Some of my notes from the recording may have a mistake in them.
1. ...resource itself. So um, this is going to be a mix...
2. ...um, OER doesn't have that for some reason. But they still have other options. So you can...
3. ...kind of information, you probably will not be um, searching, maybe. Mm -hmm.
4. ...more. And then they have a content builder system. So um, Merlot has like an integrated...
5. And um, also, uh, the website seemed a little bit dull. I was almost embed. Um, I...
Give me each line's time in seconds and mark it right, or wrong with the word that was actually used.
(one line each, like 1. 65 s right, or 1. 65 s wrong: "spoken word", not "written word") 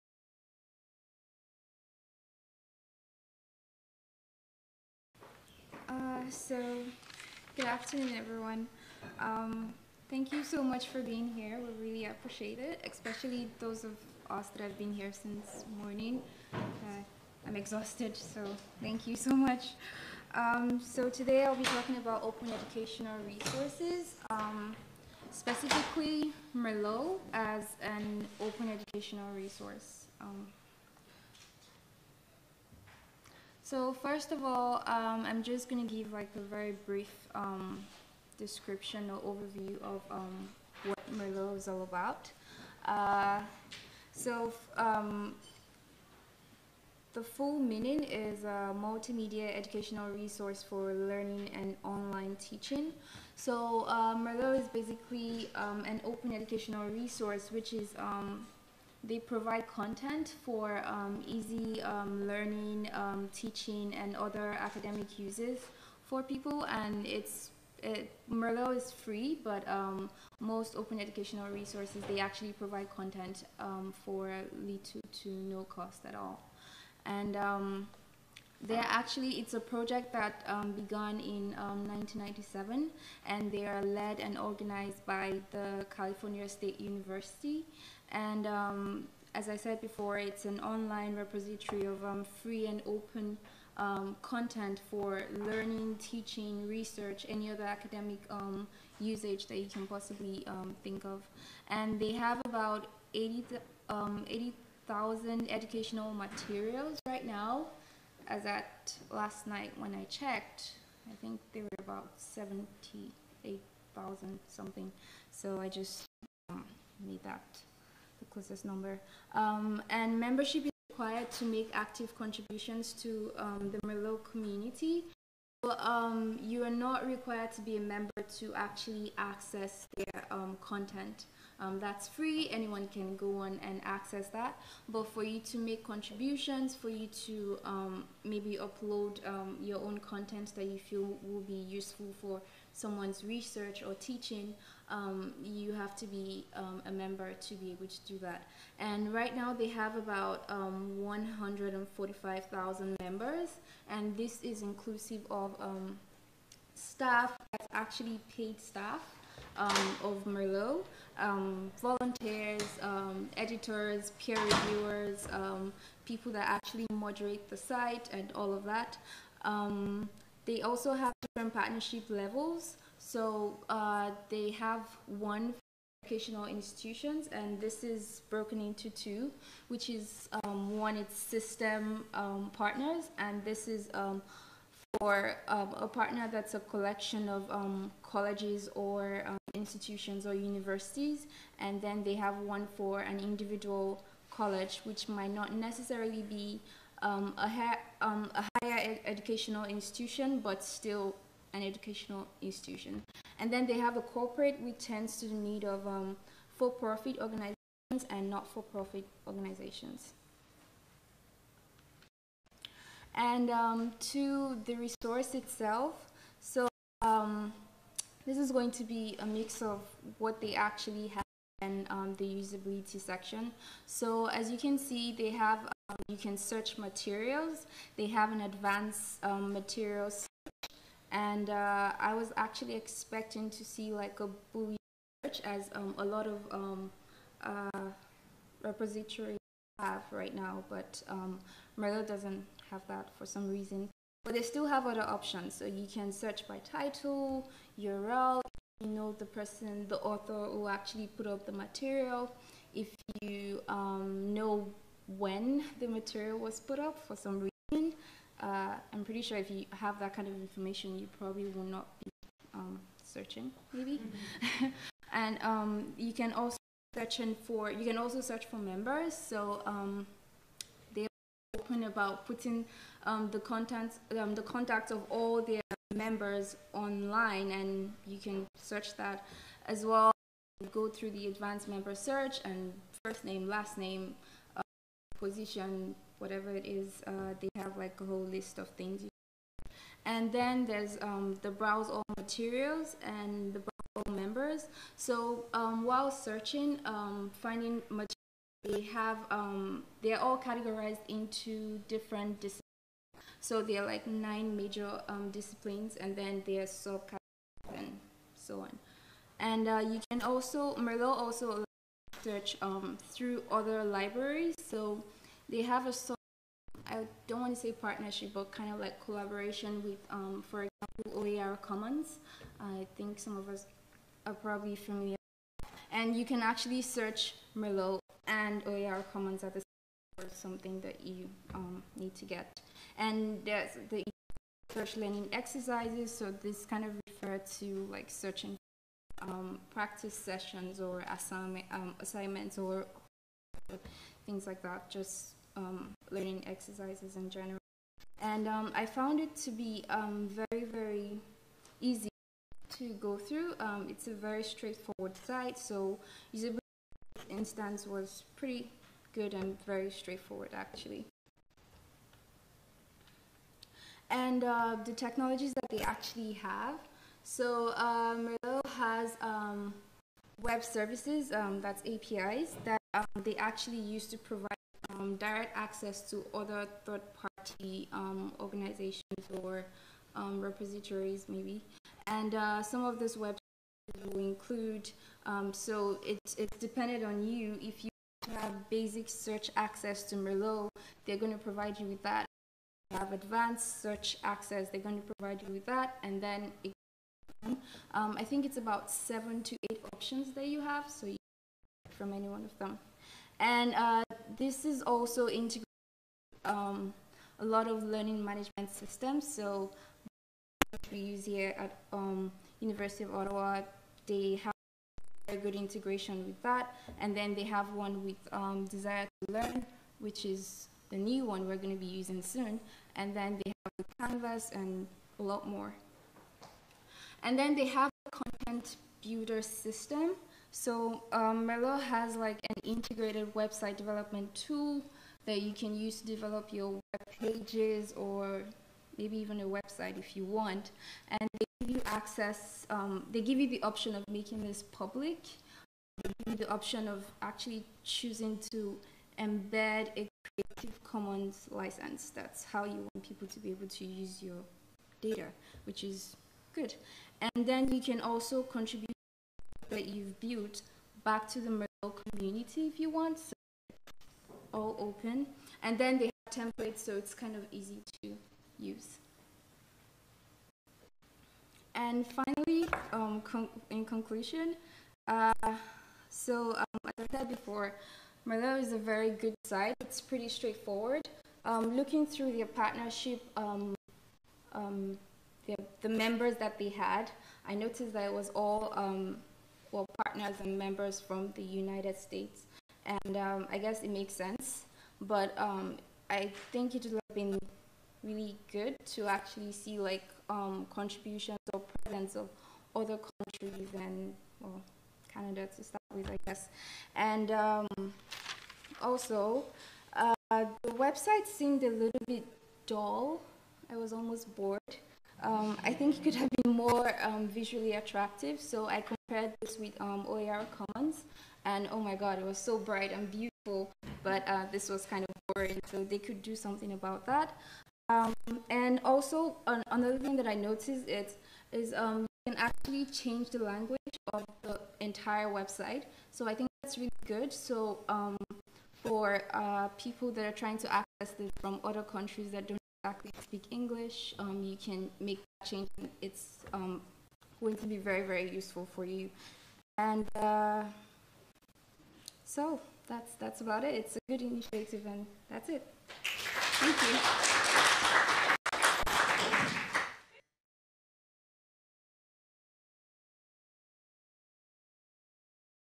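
1. 214 s right
2. 241 s wrong: "Merlot", not "OER"
3. 260 s right
4. 425 s right
5. 506 s wrong: "bored", not "embed".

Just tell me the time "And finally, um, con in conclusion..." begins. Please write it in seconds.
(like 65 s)
471 s.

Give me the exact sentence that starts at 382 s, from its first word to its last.
And uh, some of those websites will include, um, so it's, it's dependent on you.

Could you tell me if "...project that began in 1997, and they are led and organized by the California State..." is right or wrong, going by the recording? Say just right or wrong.
right.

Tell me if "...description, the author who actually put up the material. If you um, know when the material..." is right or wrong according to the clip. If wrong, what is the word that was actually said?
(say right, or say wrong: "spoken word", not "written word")
wrong: "person", not "description".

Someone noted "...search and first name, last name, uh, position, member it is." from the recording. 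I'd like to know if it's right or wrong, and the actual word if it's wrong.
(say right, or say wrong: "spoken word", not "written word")
wrong: "whatever", not "member".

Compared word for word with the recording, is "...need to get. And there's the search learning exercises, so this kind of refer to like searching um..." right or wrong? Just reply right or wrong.
right.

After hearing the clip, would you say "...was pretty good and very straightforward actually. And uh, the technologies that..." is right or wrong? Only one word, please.
right.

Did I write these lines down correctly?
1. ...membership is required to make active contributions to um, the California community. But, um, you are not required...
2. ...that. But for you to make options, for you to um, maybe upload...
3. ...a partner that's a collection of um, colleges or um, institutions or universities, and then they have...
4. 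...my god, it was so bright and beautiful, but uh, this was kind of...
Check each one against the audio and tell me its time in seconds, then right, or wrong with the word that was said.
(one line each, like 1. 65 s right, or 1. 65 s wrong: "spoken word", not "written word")
1. 120 s wrong: "Merlot", not "California"
2. 134 s wrong: "contributions", not "options"
3. 185 s right
4. 521 s right.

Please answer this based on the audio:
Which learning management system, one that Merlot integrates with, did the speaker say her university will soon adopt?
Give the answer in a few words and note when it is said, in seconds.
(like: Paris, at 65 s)
Desire to Learn, at 418 s.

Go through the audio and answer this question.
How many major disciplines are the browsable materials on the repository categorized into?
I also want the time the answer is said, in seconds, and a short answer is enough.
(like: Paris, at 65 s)
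Nine, at 304 s.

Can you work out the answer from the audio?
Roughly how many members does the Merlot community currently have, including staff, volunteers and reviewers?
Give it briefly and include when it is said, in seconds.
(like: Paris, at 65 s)
145,000, at 150 s.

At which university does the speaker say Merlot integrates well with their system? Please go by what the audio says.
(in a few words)
University of Ottawa.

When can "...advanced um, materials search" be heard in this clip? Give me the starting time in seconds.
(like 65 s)
228 s.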